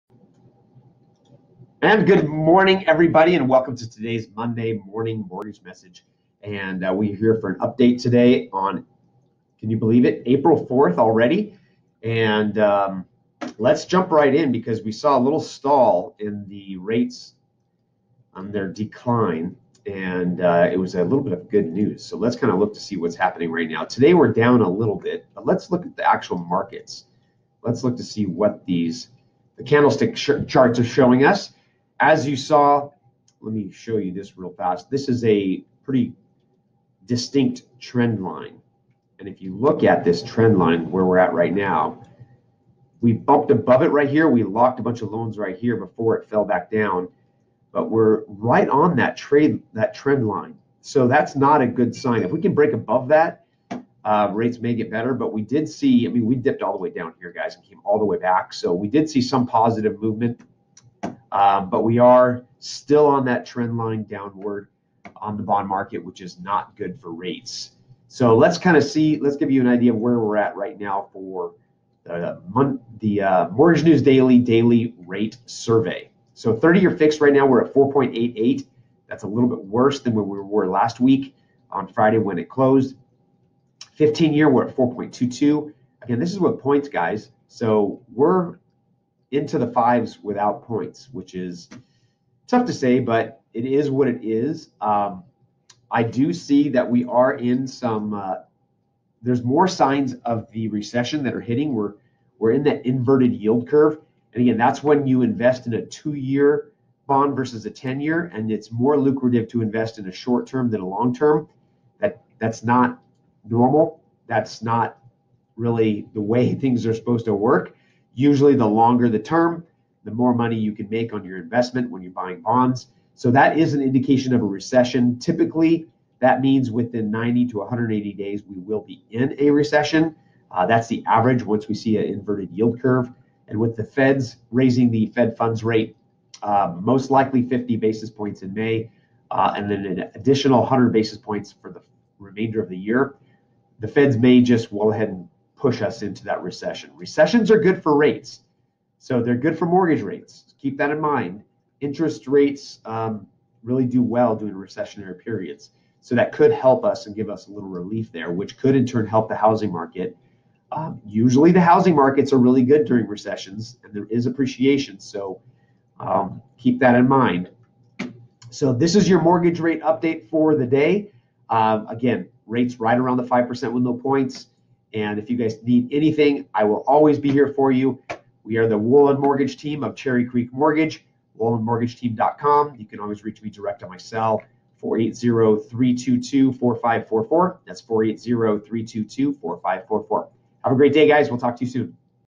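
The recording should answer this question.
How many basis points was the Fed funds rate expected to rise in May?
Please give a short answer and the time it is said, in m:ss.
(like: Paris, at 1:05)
50, at 2:17.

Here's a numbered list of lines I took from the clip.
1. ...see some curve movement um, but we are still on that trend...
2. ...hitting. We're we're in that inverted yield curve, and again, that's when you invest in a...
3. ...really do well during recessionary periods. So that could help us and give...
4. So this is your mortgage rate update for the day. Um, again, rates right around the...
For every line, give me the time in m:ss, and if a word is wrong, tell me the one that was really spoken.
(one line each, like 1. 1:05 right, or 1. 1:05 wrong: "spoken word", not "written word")
1. 0:59 wrong: "positive", not "curve"
2. 1:41 right
3. 2:33 right
4. 2:48 right.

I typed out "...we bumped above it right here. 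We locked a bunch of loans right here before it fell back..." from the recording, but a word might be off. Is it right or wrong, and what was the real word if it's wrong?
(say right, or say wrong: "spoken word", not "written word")
right.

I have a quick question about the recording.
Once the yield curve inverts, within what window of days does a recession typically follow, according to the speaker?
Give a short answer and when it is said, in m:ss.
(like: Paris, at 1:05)
90 to 180 days, at 2:07.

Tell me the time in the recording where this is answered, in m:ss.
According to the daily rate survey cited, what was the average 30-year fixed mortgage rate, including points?
1:17.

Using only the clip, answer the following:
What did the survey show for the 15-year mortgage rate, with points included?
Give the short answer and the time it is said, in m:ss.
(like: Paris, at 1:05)
4.22, at 1:24.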